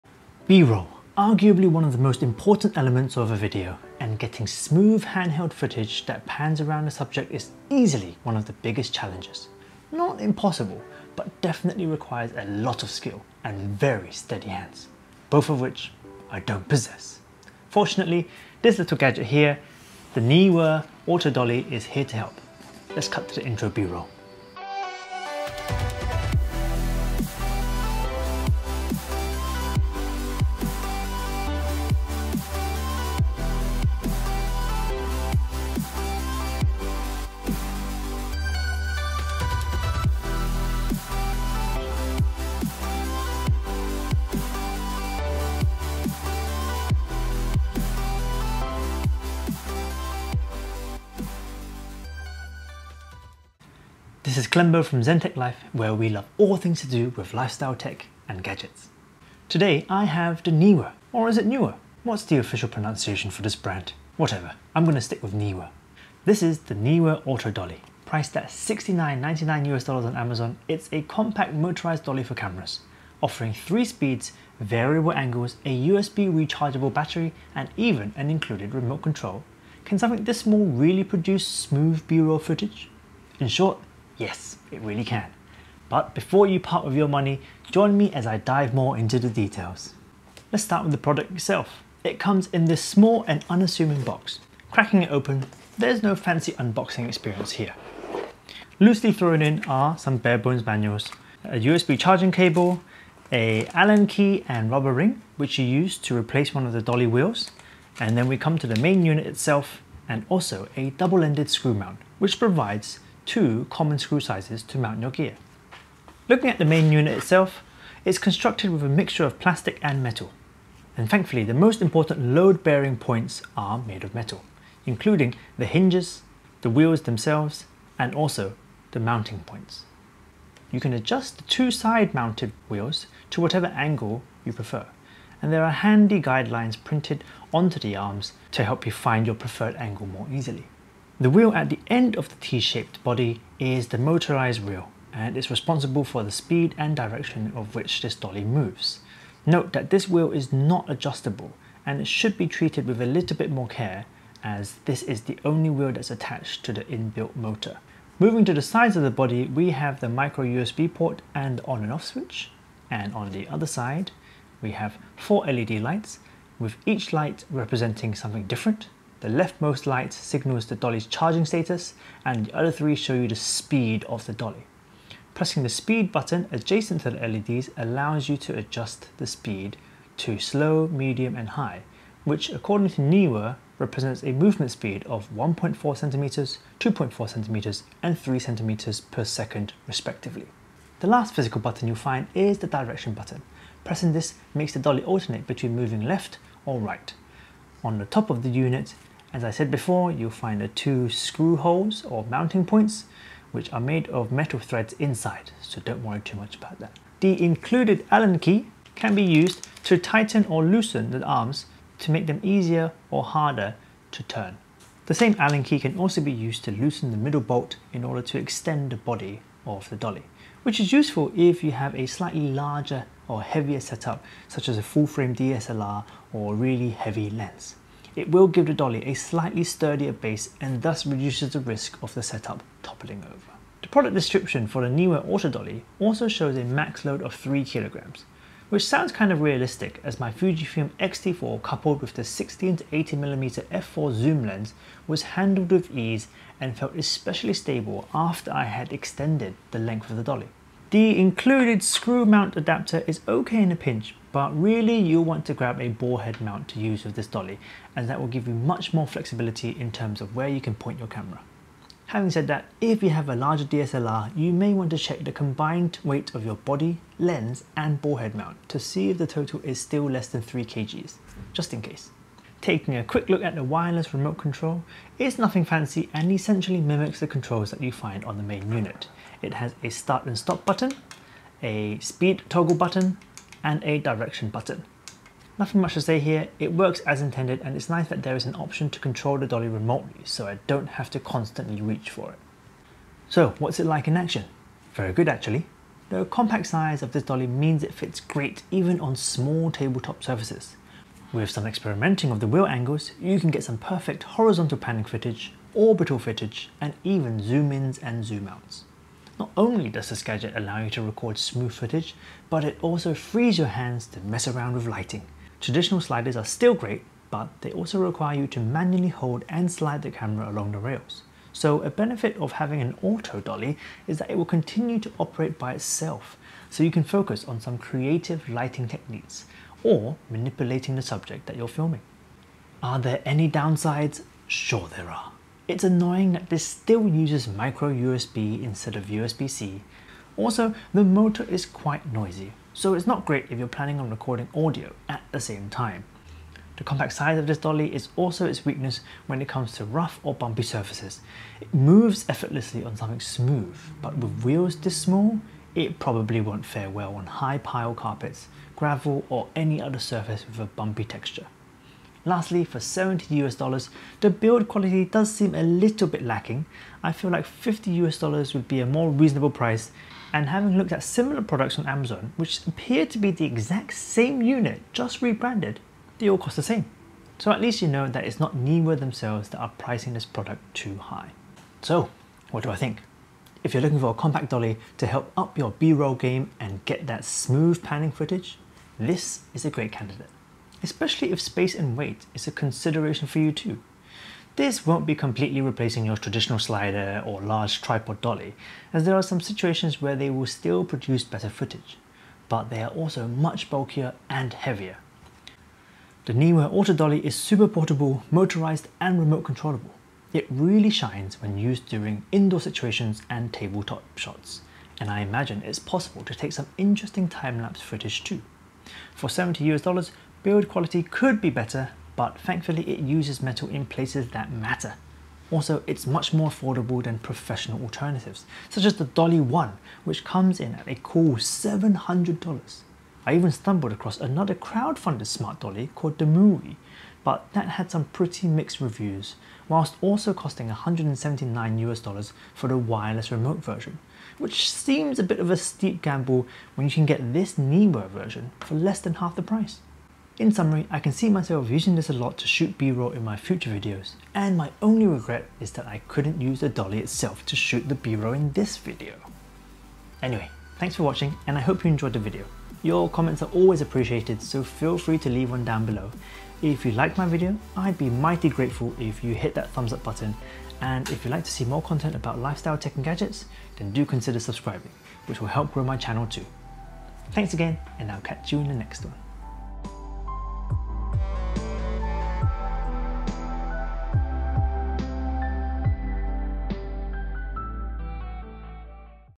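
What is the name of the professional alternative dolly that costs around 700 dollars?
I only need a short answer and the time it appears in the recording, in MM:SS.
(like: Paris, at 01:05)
Dolly 1, at 07:09.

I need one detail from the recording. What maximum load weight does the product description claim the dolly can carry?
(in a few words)
3 kilograms.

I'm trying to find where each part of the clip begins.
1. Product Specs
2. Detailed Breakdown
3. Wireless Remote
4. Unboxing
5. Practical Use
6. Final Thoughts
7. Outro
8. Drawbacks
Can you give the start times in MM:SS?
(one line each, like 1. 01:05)
1. 00:59
2. 01:55
3. 04:32
4. 01:30
5. 04:52
6. 06:21
7. 07:39
8. 05:32.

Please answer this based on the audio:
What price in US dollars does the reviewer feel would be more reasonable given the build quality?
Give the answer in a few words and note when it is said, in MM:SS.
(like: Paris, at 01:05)
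50, at 06:07.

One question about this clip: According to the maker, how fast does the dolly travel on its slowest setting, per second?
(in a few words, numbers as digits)
1.4 centimeters.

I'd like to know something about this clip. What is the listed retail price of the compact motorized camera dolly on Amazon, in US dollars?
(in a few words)
69.99.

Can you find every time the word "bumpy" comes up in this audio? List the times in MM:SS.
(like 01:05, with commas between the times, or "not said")
05:50, 06:00.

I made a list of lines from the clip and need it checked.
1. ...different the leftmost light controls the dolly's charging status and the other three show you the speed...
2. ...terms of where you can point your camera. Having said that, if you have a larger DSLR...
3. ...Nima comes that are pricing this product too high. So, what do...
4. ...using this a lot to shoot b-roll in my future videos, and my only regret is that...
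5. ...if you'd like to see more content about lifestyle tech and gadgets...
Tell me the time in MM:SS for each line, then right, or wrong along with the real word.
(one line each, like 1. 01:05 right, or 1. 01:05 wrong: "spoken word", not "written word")
1. 02:48 wrong: "signals", not "controls"
2. 04:19 right
3. 06:18 wrong: "themselves", not "comes"
4. 07:31 right
5. 07:51 right.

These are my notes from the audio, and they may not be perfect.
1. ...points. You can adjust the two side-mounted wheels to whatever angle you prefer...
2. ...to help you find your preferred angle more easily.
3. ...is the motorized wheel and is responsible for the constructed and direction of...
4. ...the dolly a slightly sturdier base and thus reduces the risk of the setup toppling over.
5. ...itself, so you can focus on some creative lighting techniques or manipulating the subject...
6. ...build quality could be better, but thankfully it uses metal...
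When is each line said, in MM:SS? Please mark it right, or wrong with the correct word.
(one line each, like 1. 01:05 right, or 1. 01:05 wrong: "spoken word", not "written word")
1. 02:09 right
2. 02:18 right
3. 02:23 wrong: "speed", not "constructed"
4. 03:48 right
5. 05:25 right
6. 07:00 right.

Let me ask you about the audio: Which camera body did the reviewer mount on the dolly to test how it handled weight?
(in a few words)
Fujifilm X-T4.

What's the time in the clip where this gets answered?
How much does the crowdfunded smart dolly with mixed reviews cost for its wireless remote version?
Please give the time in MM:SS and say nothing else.
07:20.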